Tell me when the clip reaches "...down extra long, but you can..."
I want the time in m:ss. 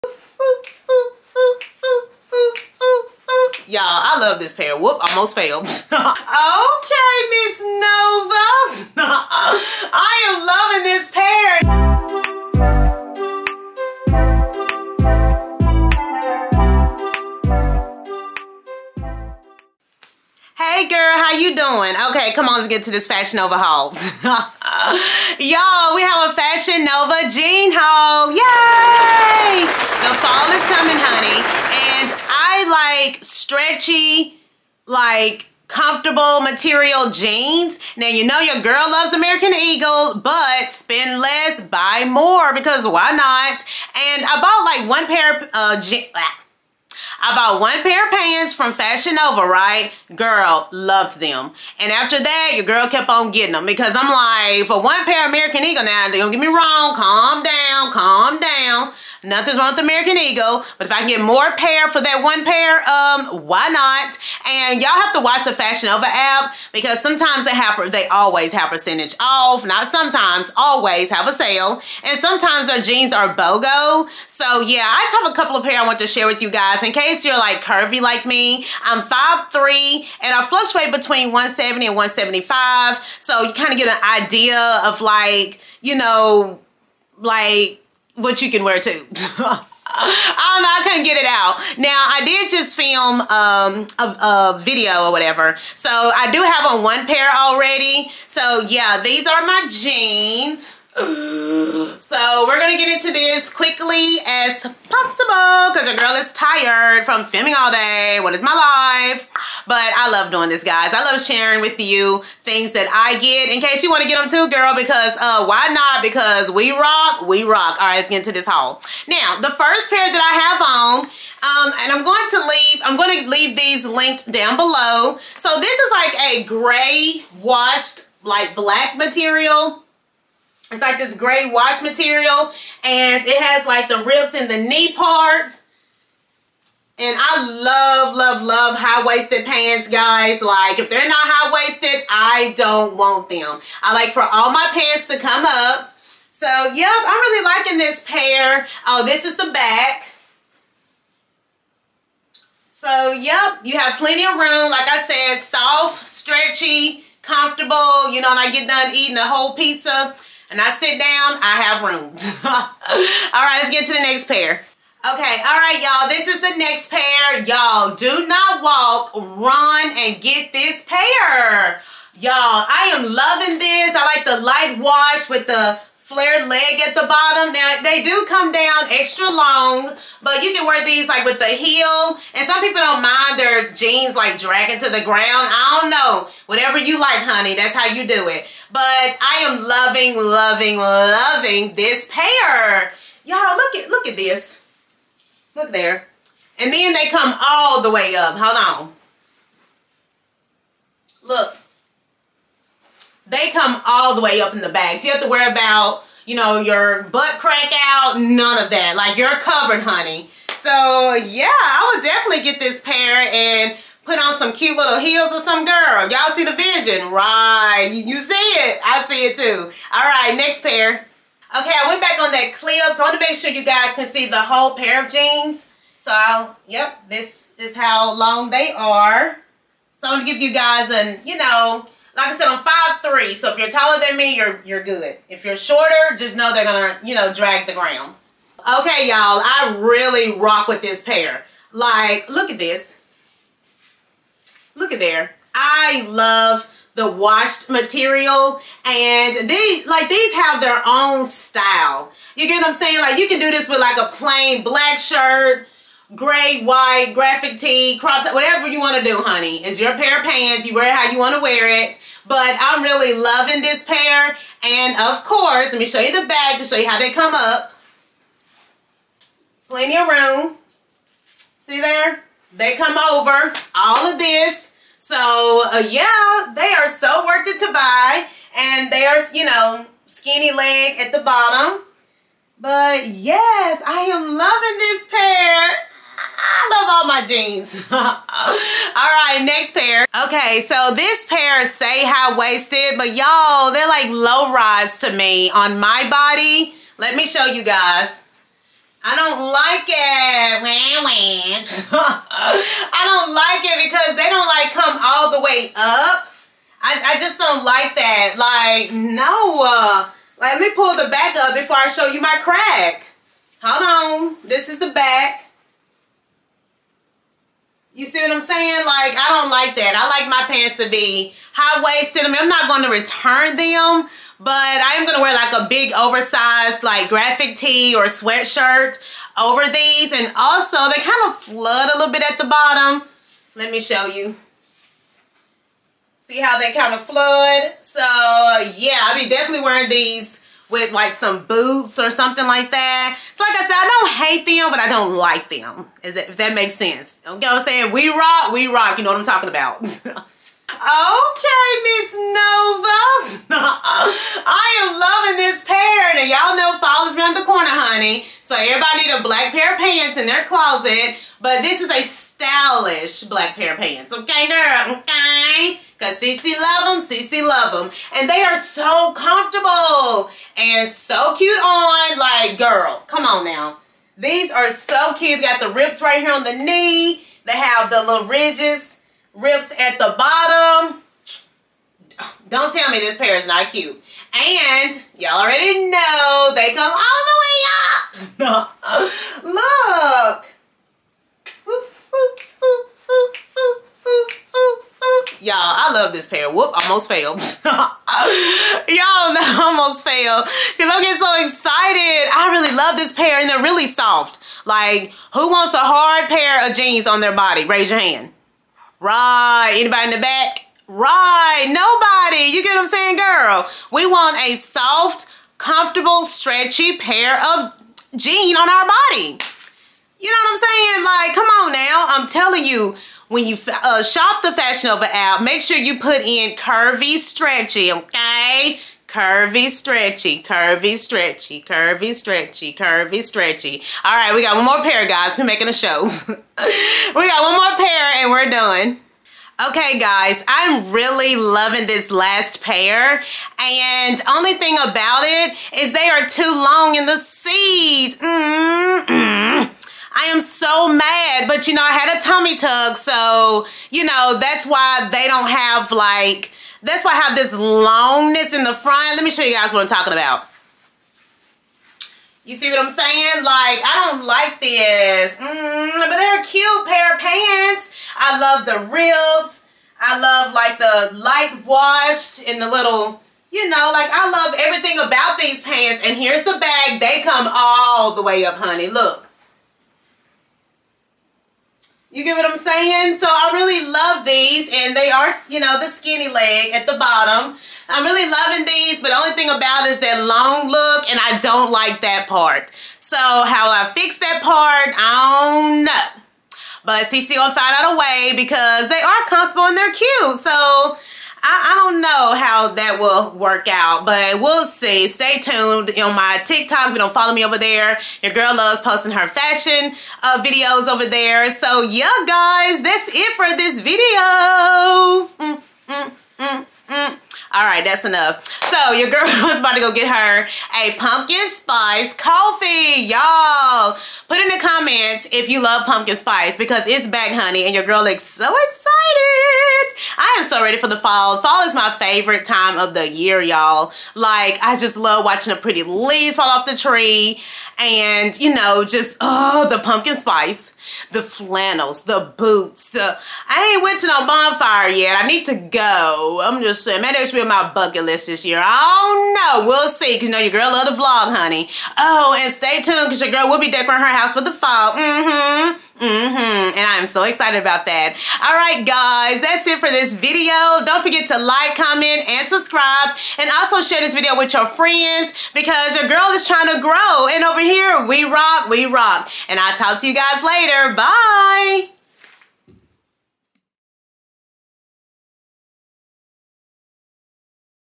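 2:58.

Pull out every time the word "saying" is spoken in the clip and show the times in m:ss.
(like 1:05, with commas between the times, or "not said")
4:12, 5:18, 5:47, 6:52, 7:00, 7:42, 8:02, 9:06.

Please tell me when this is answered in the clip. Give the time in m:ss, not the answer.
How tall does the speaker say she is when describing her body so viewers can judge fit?
1:19.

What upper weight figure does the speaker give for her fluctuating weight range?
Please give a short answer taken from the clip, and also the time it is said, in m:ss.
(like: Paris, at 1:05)
175, at 1:21.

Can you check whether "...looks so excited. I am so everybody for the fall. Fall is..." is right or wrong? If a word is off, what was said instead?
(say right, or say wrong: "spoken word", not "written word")
wrong: "ready", not "everybody".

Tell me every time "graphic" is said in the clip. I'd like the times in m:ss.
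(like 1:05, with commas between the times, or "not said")
4:17, 5:27.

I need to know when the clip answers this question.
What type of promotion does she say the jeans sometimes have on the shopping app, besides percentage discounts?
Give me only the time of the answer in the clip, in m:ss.
1:13.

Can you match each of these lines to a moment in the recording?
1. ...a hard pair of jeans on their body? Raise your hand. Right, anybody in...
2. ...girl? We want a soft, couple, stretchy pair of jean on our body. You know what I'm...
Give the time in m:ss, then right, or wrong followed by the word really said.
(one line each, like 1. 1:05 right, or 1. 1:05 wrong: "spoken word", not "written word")
1. 6:45 right
2. 6:53 wrong: "comfortable", not "couple".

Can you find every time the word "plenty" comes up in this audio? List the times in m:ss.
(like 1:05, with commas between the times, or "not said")
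2:33, 4:29.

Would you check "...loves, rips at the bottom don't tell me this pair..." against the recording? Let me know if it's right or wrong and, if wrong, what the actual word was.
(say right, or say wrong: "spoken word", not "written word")
wrong: "ridges", not "loves".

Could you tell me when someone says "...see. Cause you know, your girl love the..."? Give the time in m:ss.
9:09.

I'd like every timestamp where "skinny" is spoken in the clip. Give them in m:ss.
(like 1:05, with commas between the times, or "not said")
4:40, 8:05.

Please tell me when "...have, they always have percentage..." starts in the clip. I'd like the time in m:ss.
1:07.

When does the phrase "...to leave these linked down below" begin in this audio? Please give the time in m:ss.
2:03.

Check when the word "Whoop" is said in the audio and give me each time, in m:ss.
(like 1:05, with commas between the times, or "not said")
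0:04, 6:36.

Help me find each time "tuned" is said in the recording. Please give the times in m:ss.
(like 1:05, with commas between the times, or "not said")
8:25, 9:12.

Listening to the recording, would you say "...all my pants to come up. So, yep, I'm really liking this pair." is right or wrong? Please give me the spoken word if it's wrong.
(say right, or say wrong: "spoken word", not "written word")
right.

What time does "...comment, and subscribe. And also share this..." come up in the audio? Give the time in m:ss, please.
9:21.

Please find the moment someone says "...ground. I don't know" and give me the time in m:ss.
3:05.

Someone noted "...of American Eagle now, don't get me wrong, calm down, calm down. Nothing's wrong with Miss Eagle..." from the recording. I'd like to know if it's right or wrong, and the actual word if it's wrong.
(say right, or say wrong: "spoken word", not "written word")
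wrong: "American", not "Miss".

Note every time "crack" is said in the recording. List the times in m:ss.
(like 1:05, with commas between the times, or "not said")
3:27, 5:12.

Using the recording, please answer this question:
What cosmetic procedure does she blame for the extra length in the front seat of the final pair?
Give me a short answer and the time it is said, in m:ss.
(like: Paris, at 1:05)
tummy tuck, at 7:32.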